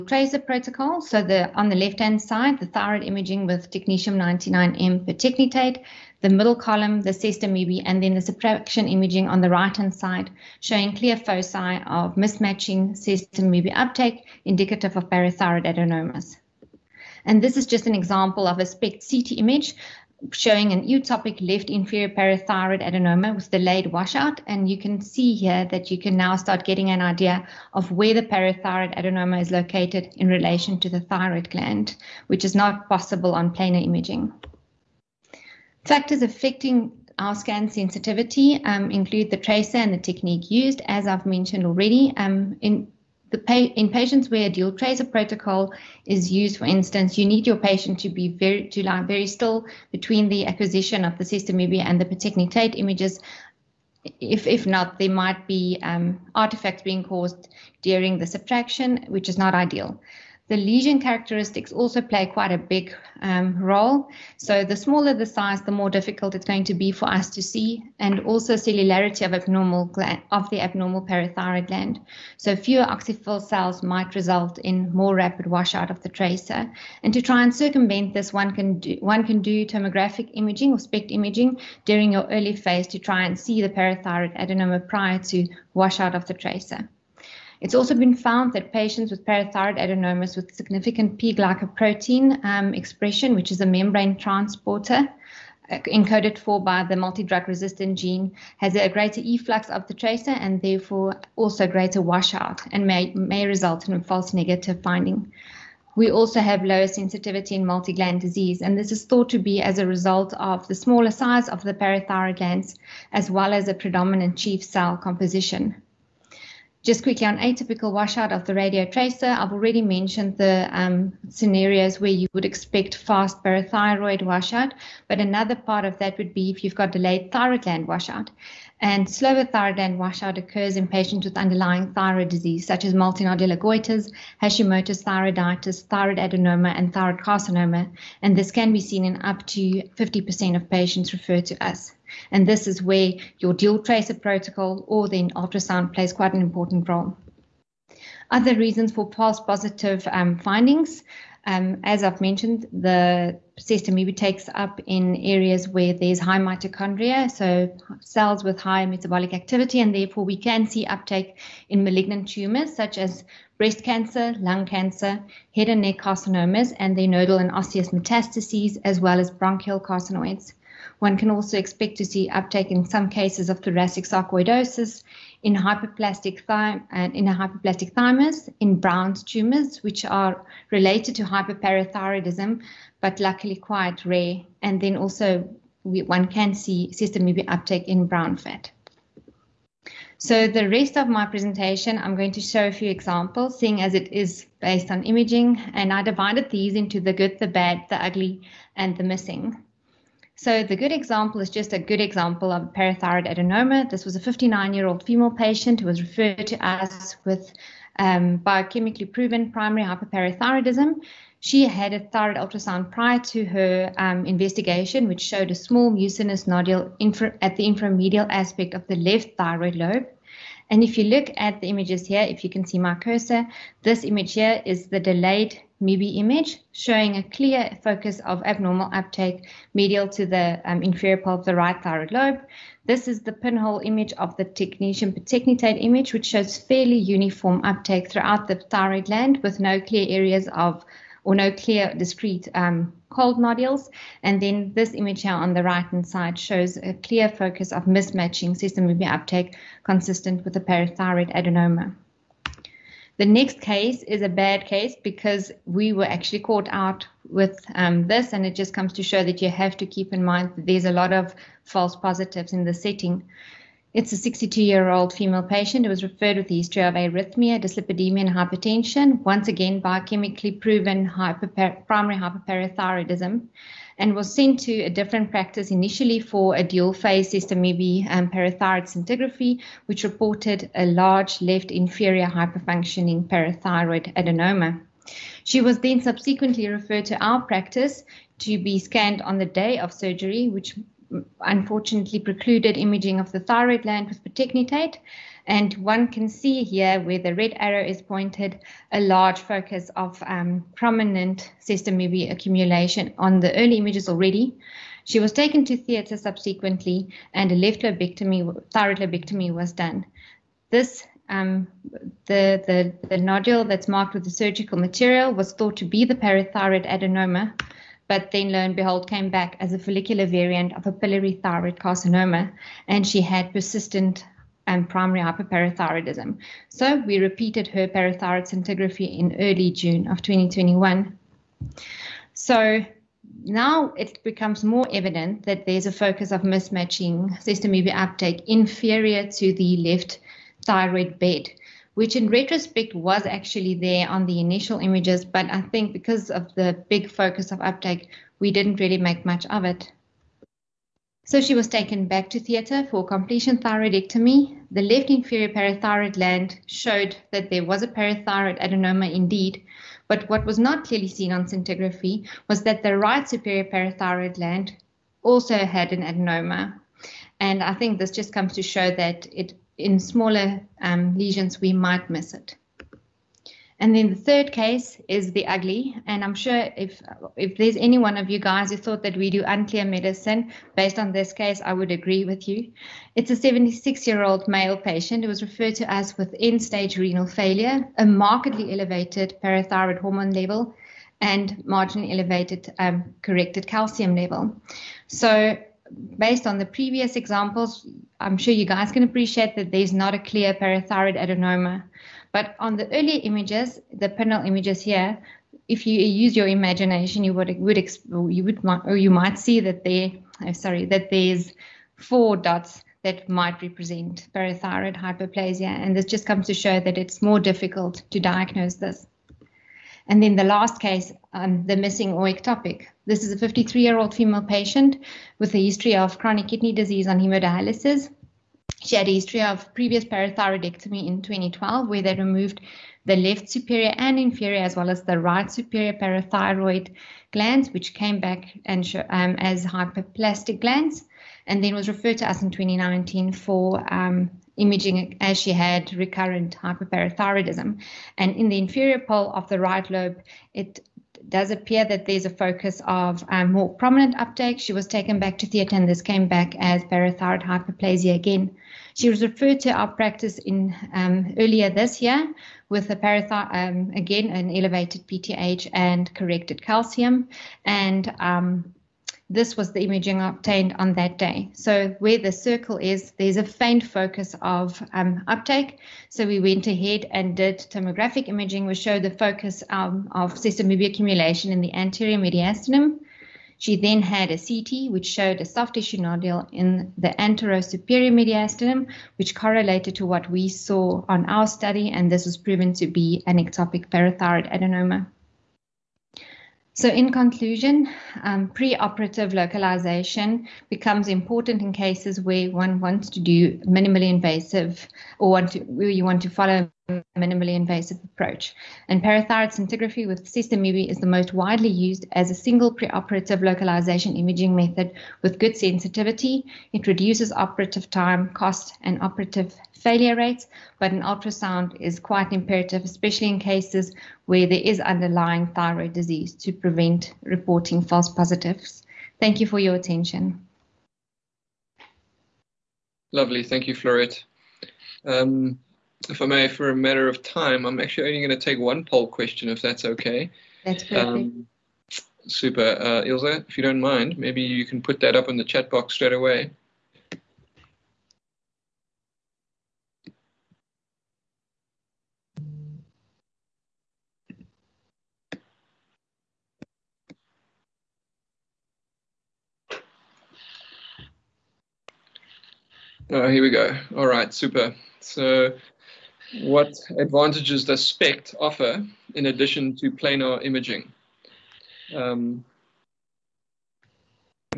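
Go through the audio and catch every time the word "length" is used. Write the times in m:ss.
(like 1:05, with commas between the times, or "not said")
not said.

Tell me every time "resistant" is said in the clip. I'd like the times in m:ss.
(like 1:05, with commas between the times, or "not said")
1:37.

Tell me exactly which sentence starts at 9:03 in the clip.
If you don't mind, maybe you can put that up in the chat box straight away.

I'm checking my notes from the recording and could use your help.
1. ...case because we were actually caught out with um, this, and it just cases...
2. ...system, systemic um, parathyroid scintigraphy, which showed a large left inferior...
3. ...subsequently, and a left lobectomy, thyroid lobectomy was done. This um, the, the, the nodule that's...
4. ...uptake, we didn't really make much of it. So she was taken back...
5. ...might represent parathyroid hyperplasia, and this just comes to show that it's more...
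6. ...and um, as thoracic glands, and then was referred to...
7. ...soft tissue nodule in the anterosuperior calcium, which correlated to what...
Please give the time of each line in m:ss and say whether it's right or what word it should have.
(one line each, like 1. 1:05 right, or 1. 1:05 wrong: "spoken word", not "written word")
1. 4:14 wrong: "comes", not "cases"
2. 4:37 wrong: "reported", not "showed"
3. 5:06 right
4. 5:47 right
5. 6:53 right
6. 7:18 wrong: "hyperplastic", not "thoracic"
7. 8:05 wrong: "mediastinum", not "calcium".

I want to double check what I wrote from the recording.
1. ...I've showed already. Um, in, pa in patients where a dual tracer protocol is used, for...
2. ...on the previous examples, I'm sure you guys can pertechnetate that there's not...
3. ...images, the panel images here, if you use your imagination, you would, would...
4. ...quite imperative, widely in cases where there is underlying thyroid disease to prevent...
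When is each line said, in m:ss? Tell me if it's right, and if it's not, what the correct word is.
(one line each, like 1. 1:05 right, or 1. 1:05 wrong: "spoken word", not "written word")
1. 0:41 wrong: "mentioned", not "showed"
2. 6:36 wrong: "appreciate", not "pertechnetate"
3. 6:43 right
4. 8:41 wrong: "especially", not "widely".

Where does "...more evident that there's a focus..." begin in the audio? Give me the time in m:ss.
5:34.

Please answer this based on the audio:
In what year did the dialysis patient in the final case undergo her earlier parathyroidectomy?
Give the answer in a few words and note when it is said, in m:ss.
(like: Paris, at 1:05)
2012, at 7:11.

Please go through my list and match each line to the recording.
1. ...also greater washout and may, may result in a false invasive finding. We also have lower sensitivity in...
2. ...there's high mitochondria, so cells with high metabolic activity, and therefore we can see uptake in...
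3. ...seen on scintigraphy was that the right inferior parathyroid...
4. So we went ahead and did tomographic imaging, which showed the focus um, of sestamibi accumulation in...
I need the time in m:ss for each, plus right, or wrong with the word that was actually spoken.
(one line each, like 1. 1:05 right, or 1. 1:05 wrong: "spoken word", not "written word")
1. 1:41 wrong: "negative", not "invasive"
2. 2:35 right
3. 6:01 wrong: "superior", not "inferior"
4. 7:56 right.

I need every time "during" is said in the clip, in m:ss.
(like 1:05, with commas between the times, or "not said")
0:57, 1:21.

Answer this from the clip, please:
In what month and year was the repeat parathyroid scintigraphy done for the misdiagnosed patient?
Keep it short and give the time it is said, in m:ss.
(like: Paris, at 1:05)
June 2021, at 5:29.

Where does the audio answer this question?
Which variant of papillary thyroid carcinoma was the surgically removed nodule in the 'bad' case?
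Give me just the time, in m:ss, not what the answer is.
5:19.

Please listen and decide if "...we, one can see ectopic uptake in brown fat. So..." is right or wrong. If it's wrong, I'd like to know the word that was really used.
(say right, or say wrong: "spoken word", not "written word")
wrong: "systemic", not "ectopic".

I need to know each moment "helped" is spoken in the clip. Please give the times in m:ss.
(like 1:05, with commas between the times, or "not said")
not said.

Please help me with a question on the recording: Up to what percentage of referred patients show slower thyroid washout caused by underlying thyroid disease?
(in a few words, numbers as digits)
50%.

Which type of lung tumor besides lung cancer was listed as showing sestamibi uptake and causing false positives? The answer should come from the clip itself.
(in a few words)
Bronchial carcinoids.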